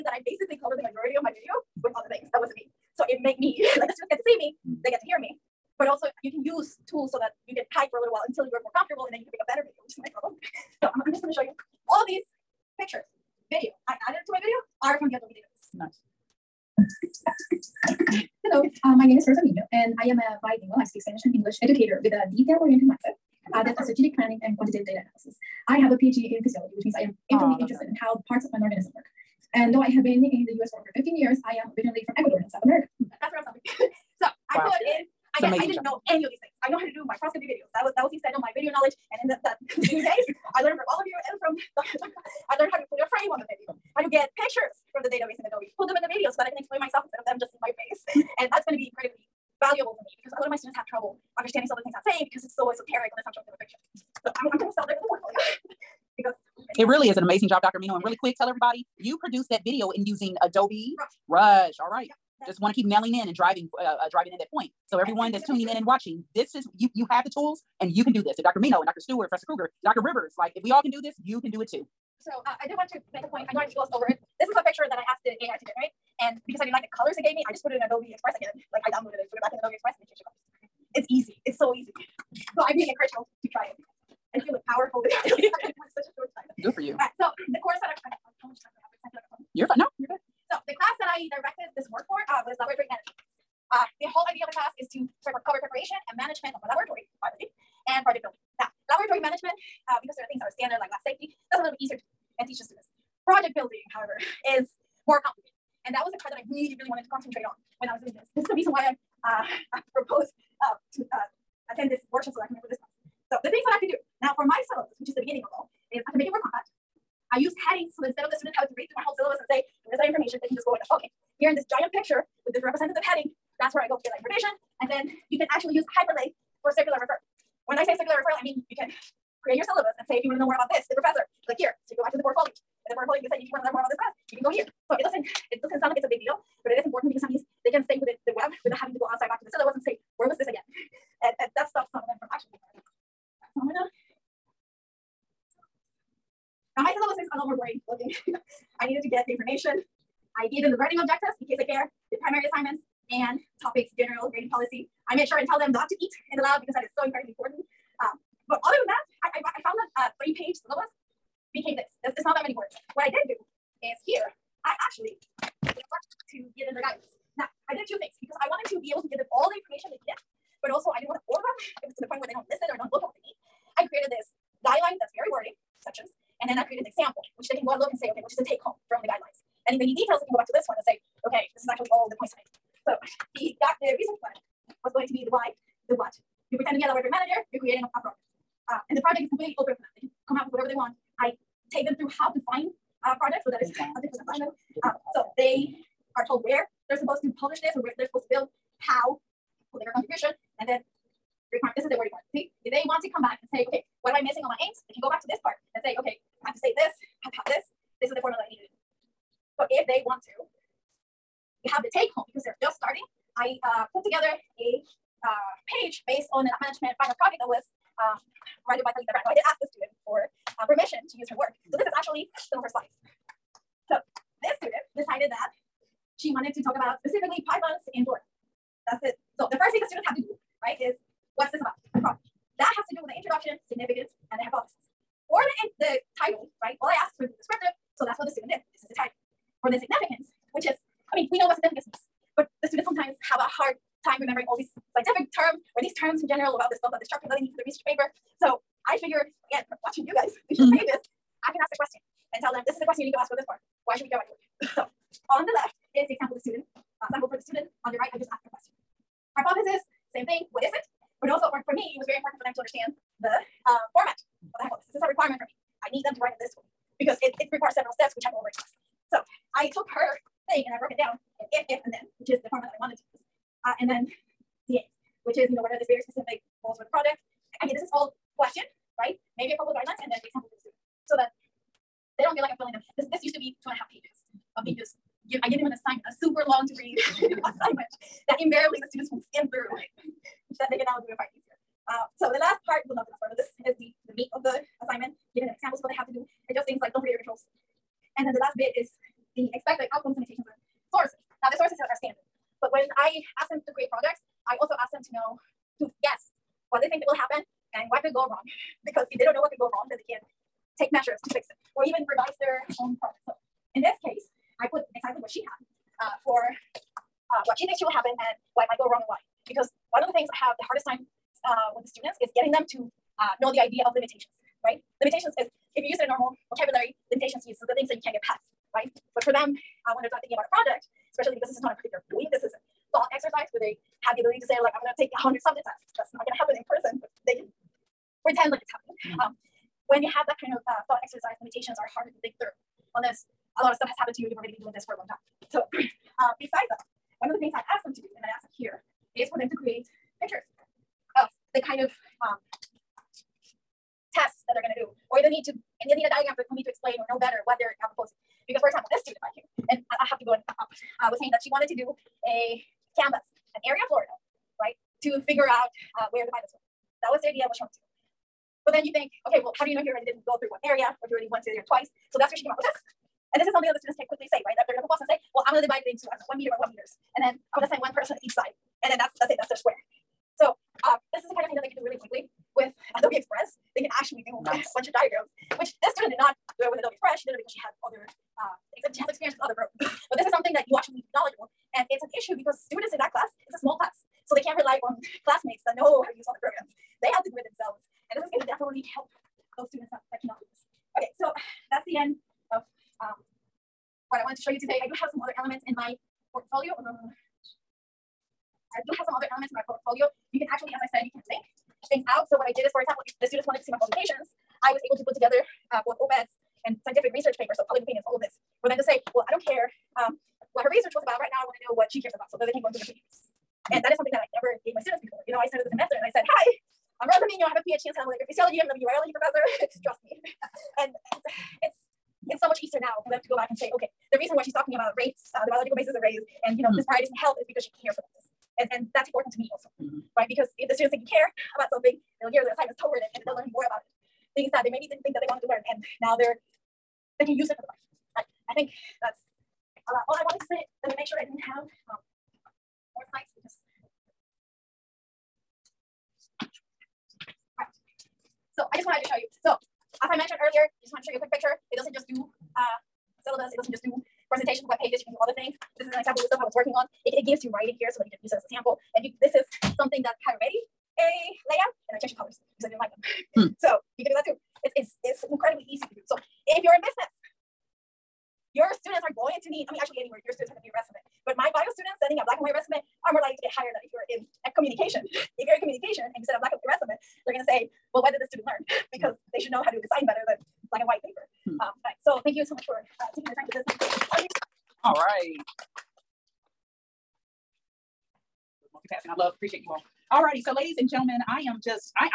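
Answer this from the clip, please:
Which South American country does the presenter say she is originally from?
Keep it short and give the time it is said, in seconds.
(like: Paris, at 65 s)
Ecuador, at 32 s.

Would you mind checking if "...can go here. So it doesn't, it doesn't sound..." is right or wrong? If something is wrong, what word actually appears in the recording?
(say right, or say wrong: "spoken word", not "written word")
right.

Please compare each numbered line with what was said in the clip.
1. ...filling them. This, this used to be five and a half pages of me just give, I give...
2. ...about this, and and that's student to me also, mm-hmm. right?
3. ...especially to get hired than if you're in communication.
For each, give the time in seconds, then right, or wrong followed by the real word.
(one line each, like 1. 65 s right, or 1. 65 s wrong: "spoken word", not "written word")
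1. 282 s wrong: "two", not "five"
2. 437 s wrong: "important", not "student"
3. 483 s wrong: "likely", not "especially".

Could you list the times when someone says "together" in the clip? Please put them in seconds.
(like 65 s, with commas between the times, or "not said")
214 s, 415 s.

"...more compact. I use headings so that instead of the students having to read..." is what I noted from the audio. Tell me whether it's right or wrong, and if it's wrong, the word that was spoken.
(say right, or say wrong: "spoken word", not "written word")
right.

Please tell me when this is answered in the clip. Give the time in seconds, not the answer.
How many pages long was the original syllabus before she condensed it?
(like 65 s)
160 s.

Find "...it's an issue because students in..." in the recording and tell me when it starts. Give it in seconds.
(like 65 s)
391 s.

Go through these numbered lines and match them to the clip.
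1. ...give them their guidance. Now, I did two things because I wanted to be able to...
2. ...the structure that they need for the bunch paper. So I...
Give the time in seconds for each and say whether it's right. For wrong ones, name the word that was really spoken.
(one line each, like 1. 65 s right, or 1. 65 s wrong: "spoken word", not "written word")
1. 166 s right
2. 247 s wrong: "research", not "bunch".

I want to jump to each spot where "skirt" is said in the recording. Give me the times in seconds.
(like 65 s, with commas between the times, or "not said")
not said.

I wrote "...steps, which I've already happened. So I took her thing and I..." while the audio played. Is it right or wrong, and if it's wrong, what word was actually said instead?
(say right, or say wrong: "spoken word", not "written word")
wrong: "asked", not "happened".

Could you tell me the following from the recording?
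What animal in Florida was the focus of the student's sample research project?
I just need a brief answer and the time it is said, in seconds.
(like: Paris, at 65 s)
Pythons, at 227 s.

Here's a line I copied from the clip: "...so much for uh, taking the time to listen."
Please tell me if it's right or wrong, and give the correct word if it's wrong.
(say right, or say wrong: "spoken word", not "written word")
right.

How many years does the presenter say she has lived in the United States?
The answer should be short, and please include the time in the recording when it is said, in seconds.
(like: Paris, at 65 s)
over 15 years, at 30 s.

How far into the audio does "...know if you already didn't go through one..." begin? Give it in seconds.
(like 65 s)
369 s.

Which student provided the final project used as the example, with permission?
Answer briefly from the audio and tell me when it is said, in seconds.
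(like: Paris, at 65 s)
Talita Brando, at 218 s.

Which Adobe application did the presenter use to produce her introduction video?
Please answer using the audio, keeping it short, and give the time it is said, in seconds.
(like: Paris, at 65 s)
Adobe Rush, at 60 s.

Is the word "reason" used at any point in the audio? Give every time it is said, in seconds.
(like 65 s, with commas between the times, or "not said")
108 s, 434 s.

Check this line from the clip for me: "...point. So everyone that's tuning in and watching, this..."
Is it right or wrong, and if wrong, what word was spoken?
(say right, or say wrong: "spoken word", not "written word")
right.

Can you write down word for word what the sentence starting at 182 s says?
So the, got the research plan was going to be the why, the what.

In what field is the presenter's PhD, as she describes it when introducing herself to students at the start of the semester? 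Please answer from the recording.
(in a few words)
Cell molecular physiology.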